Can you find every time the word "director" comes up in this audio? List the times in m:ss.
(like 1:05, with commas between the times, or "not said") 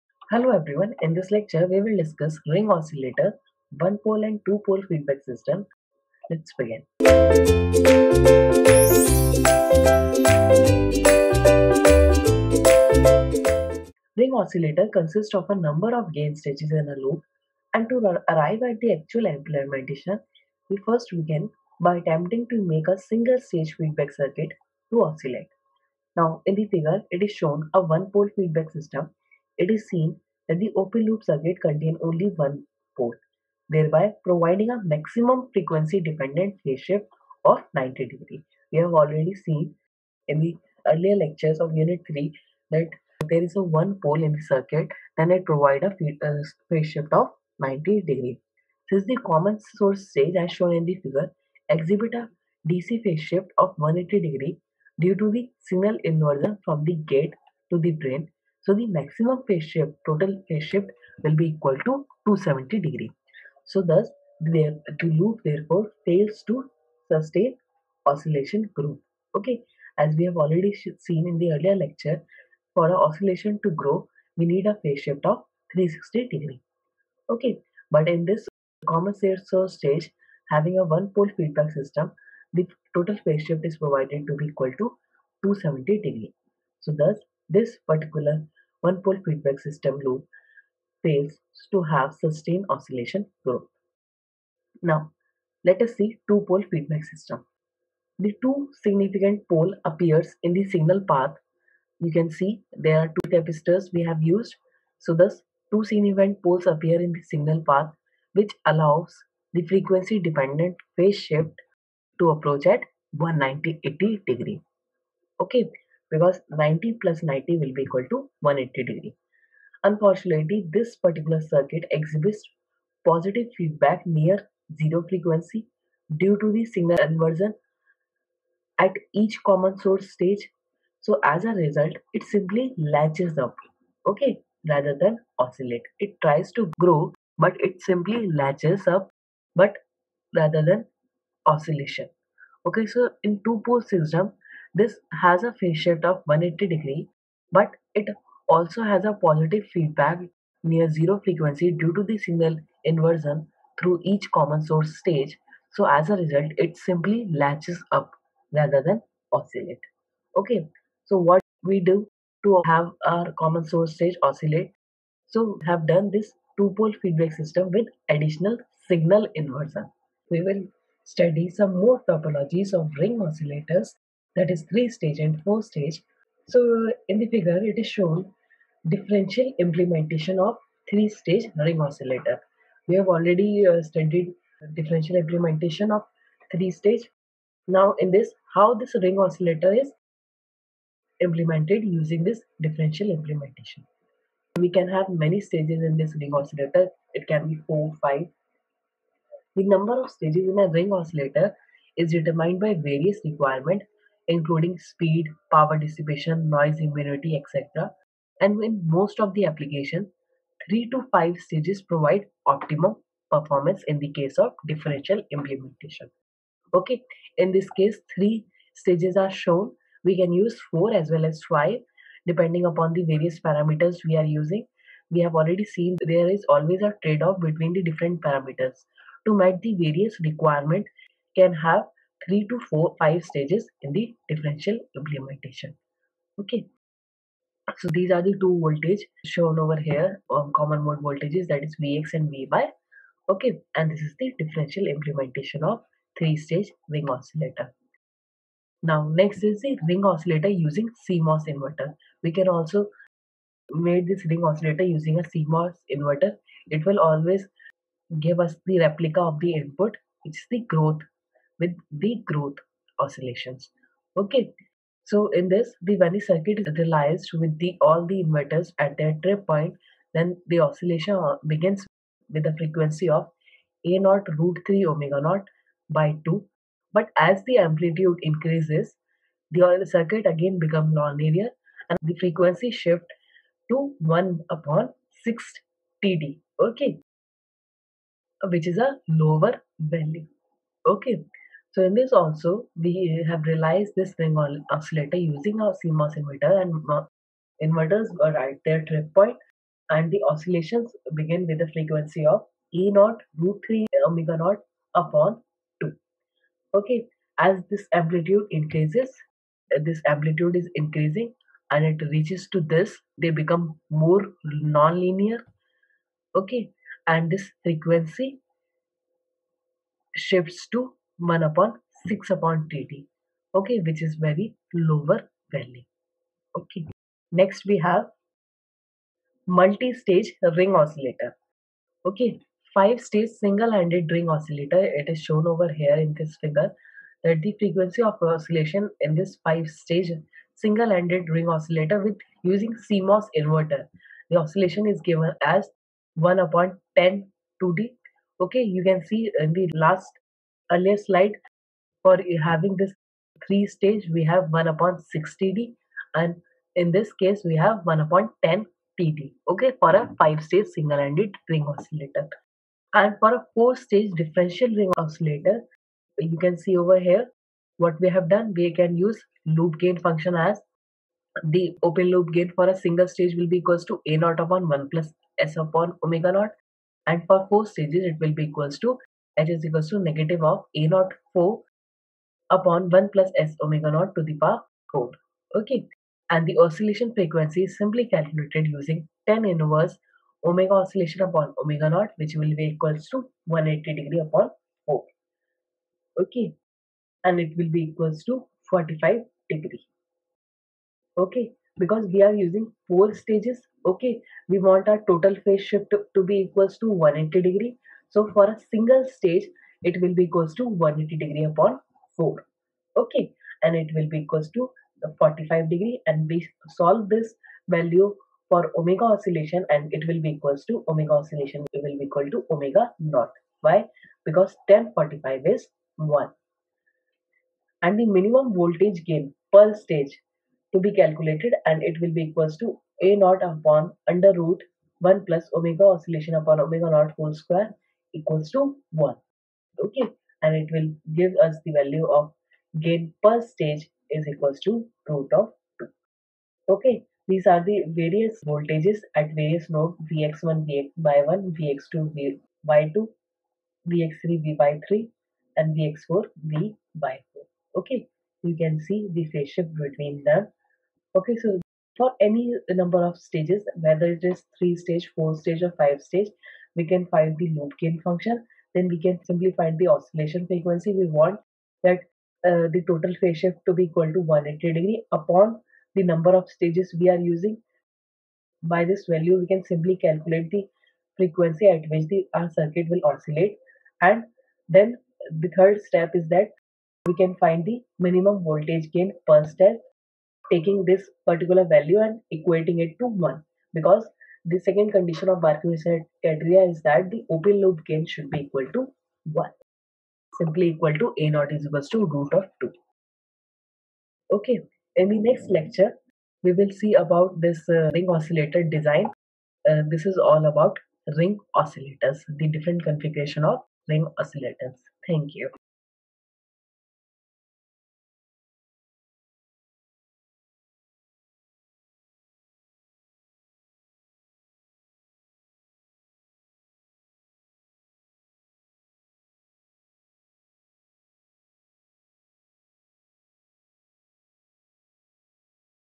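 not said.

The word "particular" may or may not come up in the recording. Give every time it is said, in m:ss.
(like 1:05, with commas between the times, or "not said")
1:27, 2:00, 8:11.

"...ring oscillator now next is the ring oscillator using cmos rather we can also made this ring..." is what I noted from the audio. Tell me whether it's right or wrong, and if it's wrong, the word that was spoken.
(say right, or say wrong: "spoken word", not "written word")
wrong: "inverter", not "rather".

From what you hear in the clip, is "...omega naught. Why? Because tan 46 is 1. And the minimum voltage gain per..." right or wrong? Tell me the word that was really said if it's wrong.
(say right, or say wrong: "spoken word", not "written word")
wrong: "45", not "46".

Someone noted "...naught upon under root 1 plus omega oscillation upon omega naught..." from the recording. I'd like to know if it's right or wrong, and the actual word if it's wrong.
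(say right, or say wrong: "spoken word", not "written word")
right.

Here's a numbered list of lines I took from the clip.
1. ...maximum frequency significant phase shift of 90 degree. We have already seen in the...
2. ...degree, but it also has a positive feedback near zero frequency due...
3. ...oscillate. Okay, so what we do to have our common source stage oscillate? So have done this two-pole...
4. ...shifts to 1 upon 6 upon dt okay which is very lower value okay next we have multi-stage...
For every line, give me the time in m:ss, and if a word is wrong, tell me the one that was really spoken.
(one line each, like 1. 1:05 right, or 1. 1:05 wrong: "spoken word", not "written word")
1. 0:34 wrong: "dependent", not "significant"
2. 2:26 right
3. 2:39 right
4. 5:20 right.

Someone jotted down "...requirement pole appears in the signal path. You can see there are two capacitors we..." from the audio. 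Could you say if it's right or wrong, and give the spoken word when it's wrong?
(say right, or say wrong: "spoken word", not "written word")
wrong: "significant", not "requirement".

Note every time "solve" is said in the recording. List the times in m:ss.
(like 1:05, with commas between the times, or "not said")
6:56.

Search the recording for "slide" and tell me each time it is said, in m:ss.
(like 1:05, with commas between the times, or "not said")
5:50.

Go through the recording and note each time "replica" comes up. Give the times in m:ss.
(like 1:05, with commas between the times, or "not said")
4:18.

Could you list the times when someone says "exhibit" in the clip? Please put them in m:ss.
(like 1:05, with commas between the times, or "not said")
0:51, 2:01.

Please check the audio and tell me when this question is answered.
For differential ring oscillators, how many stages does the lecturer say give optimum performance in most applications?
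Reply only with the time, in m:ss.
3:30.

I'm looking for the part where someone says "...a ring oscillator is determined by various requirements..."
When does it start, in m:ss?
3:20.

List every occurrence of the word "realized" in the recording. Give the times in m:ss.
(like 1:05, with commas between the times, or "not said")
4:26, 4:53.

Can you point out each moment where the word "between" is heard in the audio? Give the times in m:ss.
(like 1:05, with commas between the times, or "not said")
3:47, 7:39.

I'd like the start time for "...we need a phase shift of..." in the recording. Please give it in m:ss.
1:14.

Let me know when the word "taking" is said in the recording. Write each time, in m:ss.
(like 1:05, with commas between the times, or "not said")
8:10.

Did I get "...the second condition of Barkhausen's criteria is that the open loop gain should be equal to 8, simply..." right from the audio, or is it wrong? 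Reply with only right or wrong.
wrong.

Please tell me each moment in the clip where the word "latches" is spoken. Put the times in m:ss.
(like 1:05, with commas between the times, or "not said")
2:12, 2:18, 2:37.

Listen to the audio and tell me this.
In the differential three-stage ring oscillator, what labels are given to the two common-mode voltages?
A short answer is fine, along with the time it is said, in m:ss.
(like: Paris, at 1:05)
Vx and Vy, at 4:01.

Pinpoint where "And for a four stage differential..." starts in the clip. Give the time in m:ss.
6:02.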